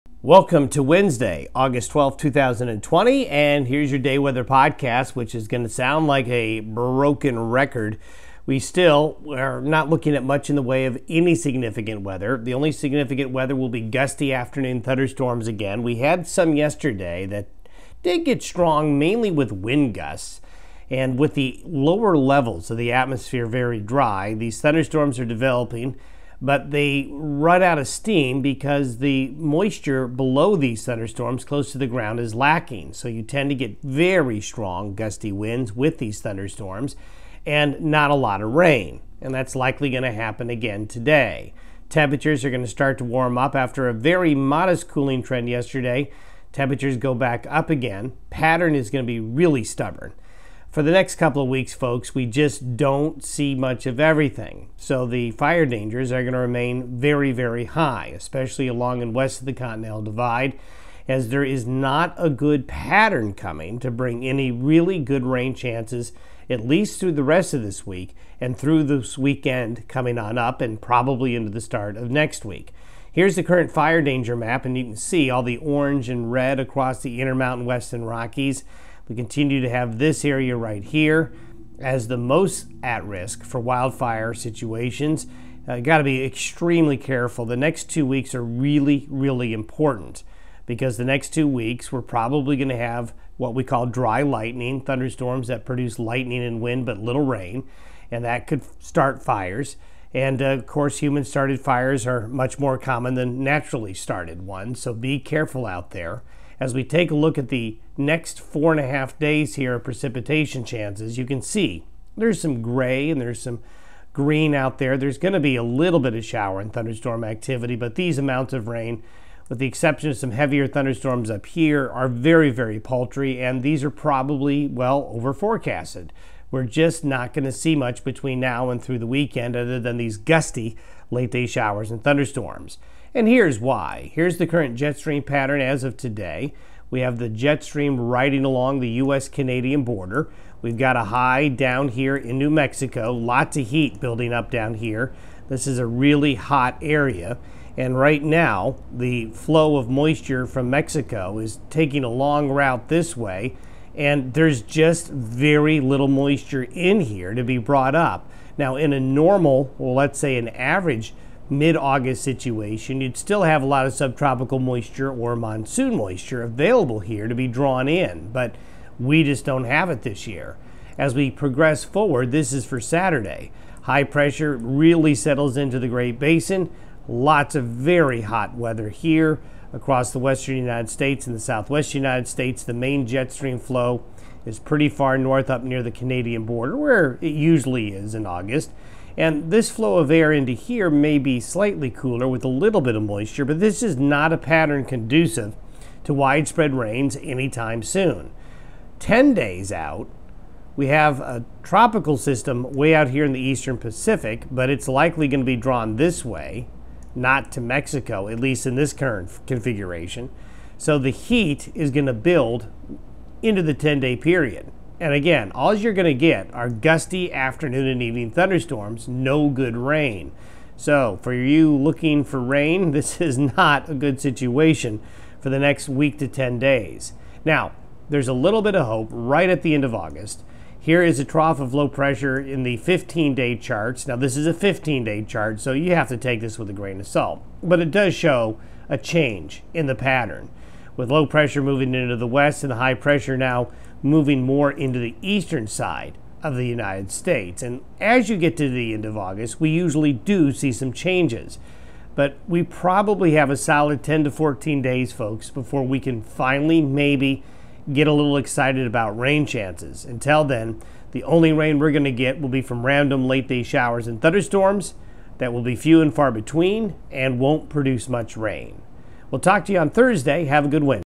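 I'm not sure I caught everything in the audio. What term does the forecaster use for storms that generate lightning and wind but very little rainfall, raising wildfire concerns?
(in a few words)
dry lightning.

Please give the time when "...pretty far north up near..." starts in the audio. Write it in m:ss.
3:04.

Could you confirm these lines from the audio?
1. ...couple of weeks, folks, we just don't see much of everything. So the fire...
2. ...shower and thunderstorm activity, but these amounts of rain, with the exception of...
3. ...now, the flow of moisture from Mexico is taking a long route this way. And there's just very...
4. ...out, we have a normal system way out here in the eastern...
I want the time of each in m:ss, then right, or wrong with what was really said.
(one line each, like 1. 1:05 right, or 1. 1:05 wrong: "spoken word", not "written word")
1. 0:51 right
2. 1:56 right
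3. 2:28 right
4. 3:19 wrong: "tropical", not "normal".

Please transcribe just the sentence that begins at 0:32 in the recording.
So you tend to get very strong gusty winds with these thunderstorms and not a lot of rain.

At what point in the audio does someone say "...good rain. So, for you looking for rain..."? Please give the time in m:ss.
3:39.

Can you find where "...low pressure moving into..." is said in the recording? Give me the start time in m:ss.
4:01.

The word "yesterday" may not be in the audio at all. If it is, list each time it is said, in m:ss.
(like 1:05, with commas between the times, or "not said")
0:16, 0:45.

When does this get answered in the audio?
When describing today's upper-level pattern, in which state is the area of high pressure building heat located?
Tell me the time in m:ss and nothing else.
2:22.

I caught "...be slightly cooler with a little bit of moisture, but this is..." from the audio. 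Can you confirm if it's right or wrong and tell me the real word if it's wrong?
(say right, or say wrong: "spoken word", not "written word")
right.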